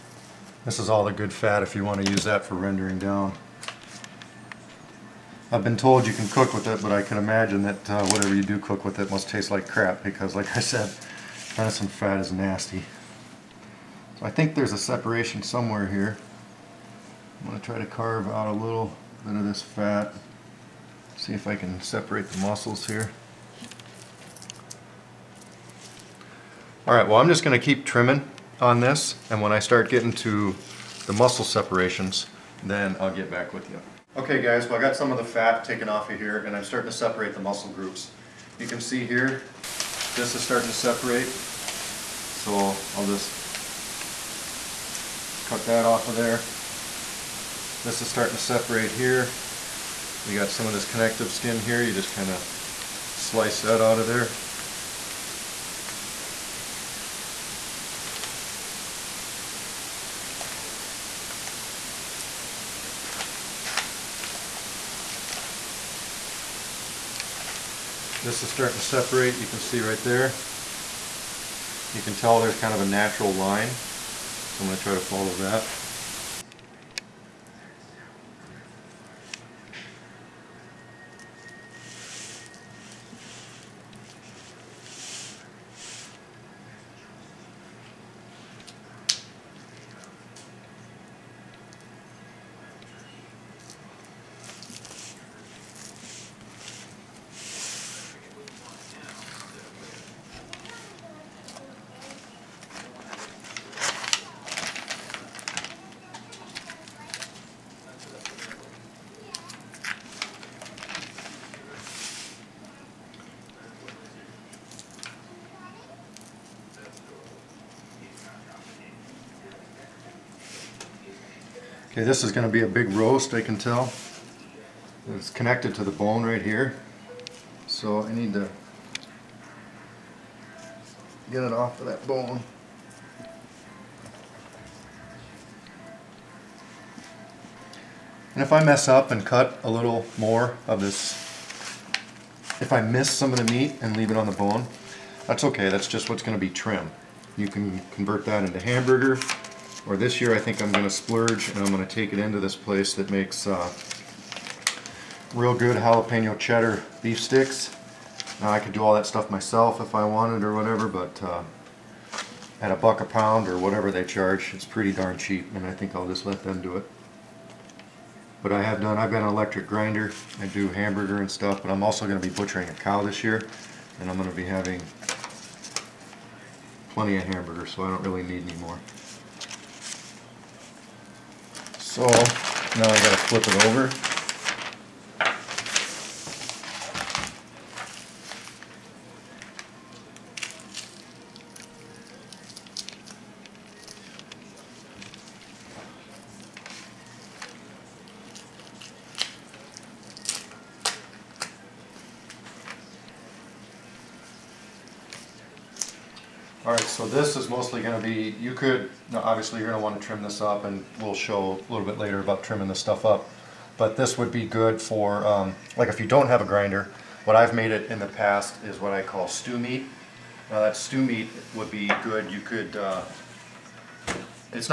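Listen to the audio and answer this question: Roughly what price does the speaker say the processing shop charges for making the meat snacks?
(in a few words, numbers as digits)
a buck a pound.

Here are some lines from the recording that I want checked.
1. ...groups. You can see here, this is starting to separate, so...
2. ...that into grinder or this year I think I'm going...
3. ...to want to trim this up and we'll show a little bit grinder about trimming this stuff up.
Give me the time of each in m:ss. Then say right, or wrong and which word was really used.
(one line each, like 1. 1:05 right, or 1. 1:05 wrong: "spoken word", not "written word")
1. 0:37 right
2. 2:28 wrong: "hamburger", not "grinder"
3. 3:29 wrong: "later", not "grinder".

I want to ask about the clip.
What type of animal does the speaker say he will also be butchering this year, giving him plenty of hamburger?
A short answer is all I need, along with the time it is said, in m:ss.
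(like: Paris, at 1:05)
cow, at 2:52.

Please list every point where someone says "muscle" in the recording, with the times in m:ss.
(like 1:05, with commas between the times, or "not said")
0:22, 0:31, 0:37.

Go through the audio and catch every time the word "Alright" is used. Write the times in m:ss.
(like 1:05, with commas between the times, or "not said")
0:26.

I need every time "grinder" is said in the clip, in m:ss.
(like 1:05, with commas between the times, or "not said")
2:49, 3:36.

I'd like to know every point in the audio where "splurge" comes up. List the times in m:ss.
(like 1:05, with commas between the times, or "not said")
2:30.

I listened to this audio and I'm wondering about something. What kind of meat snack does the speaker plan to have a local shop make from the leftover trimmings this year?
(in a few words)
jalapeno cheddar beef sticks.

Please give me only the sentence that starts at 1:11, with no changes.
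You can tell there's kind of a natural line, so I'm going to try to follow that.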